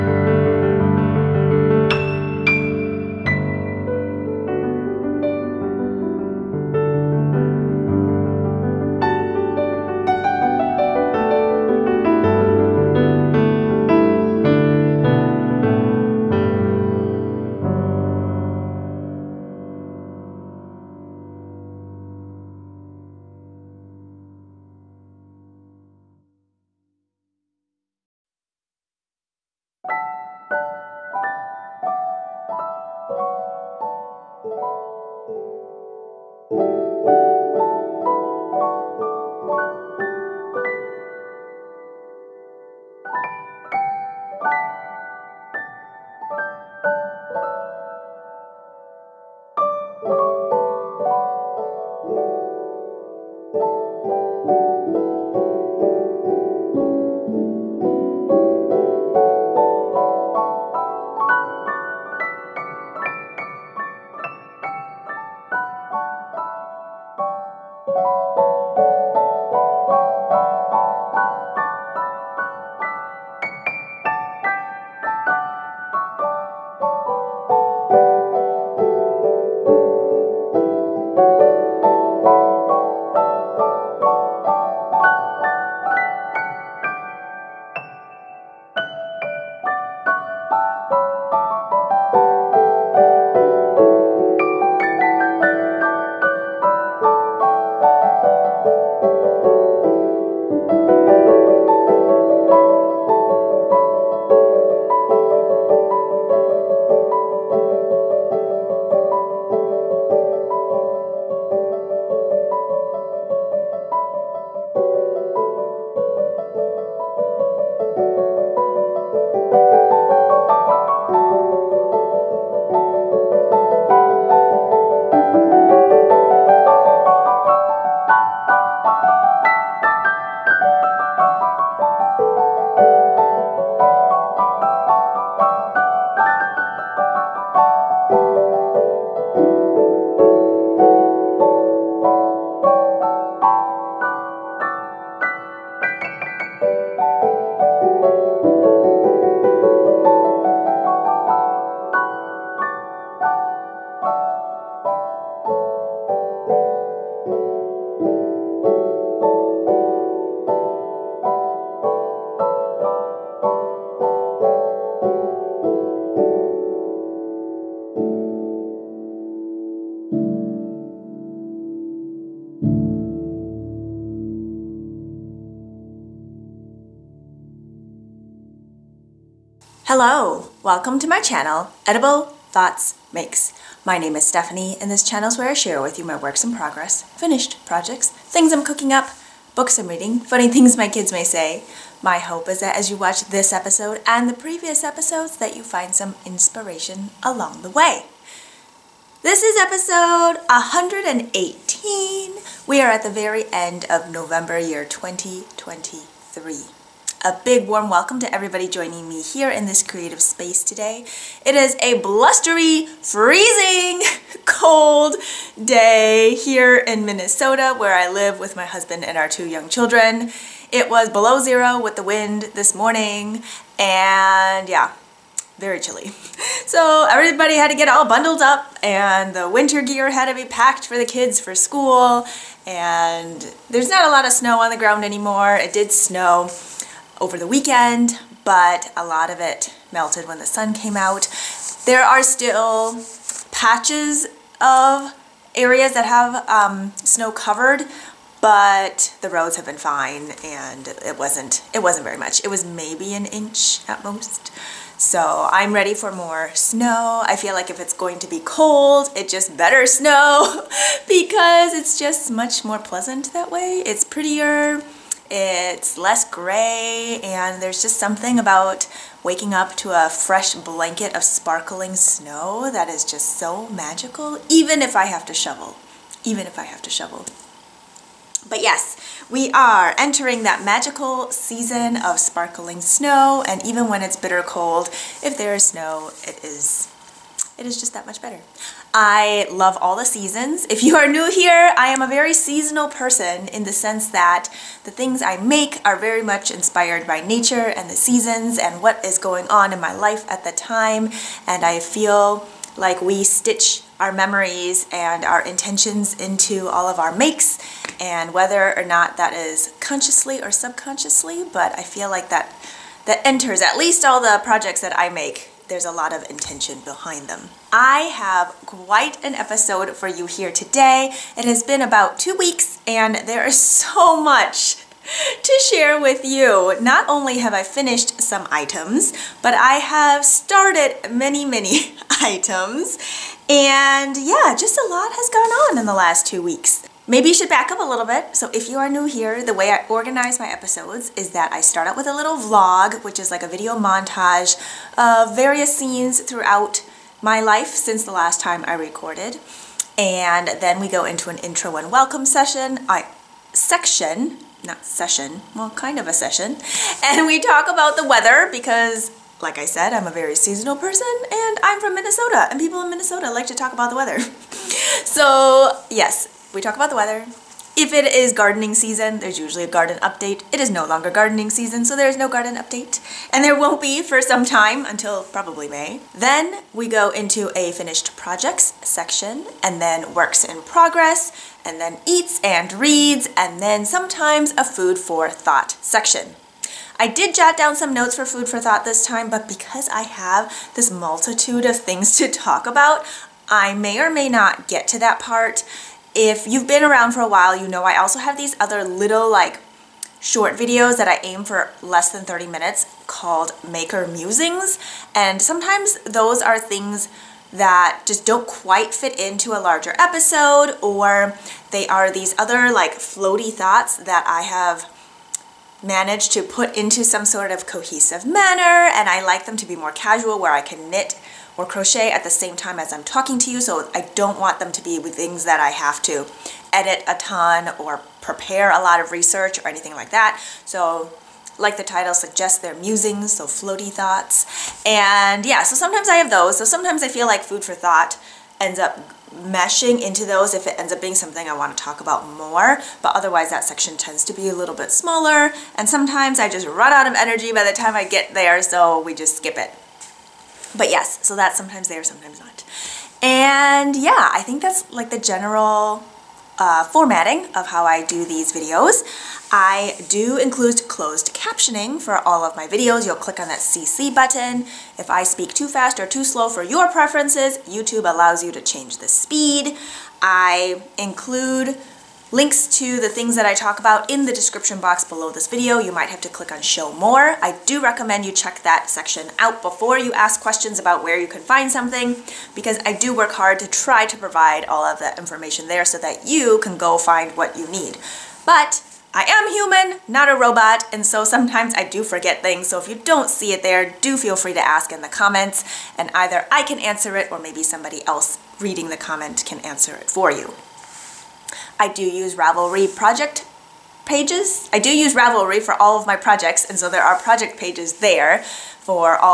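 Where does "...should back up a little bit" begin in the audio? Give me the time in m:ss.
5:37.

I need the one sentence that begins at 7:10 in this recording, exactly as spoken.
So like the title suggests, they're musings, so floaty thoughts.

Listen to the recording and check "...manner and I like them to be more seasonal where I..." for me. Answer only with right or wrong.
wrong.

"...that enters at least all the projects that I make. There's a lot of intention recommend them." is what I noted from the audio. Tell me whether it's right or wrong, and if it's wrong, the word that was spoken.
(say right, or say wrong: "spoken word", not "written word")
wrong: "behind", not "recommend".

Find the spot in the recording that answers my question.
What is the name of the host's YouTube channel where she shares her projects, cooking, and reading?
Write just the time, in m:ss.
3:01.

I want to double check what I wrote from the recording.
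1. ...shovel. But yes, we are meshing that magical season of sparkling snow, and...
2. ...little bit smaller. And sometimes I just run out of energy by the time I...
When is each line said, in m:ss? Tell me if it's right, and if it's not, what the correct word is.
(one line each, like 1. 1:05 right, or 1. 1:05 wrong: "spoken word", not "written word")
1. 4:36 wrong: "entering", not "meshing"
2. 7:24 right.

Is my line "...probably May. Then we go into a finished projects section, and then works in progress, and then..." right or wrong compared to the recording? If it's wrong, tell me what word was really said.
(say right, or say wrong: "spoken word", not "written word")
right.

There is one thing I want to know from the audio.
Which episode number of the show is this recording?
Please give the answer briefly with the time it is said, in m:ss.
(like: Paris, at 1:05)
118, at 3:20.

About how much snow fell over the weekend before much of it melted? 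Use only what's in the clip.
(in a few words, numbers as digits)
an inch.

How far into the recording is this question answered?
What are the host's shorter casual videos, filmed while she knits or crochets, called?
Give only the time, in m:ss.
6:43.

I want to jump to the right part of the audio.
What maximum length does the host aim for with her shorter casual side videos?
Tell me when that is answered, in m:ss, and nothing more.
6:42.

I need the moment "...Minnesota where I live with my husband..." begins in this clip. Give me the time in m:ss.
3:37.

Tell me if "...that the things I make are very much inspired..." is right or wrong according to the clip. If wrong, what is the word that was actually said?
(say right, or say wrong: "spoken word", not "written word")
right.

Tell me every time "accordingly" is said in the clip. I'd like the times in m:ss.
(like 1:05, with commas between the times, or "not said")
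not said.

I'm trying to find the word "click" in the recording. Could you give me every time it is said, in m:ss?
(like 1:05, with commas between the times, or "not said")
7:43, 7:56.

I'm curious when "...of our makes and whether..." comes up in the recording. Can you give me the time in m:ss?
5:06.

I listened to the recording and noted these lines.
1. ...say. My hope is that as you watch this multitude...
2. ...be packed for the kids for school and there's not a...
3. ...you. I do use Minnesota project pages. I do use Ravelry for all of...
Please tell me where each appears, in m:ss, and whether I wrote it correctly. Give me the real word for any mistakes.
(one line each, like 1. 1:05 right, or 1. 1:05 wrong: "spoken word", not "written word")
1. 3:11 wrong: "episode", not "multitude"
2. 3:50 right
3. 8:20 wrong: "Ravelry", not "Minnesota".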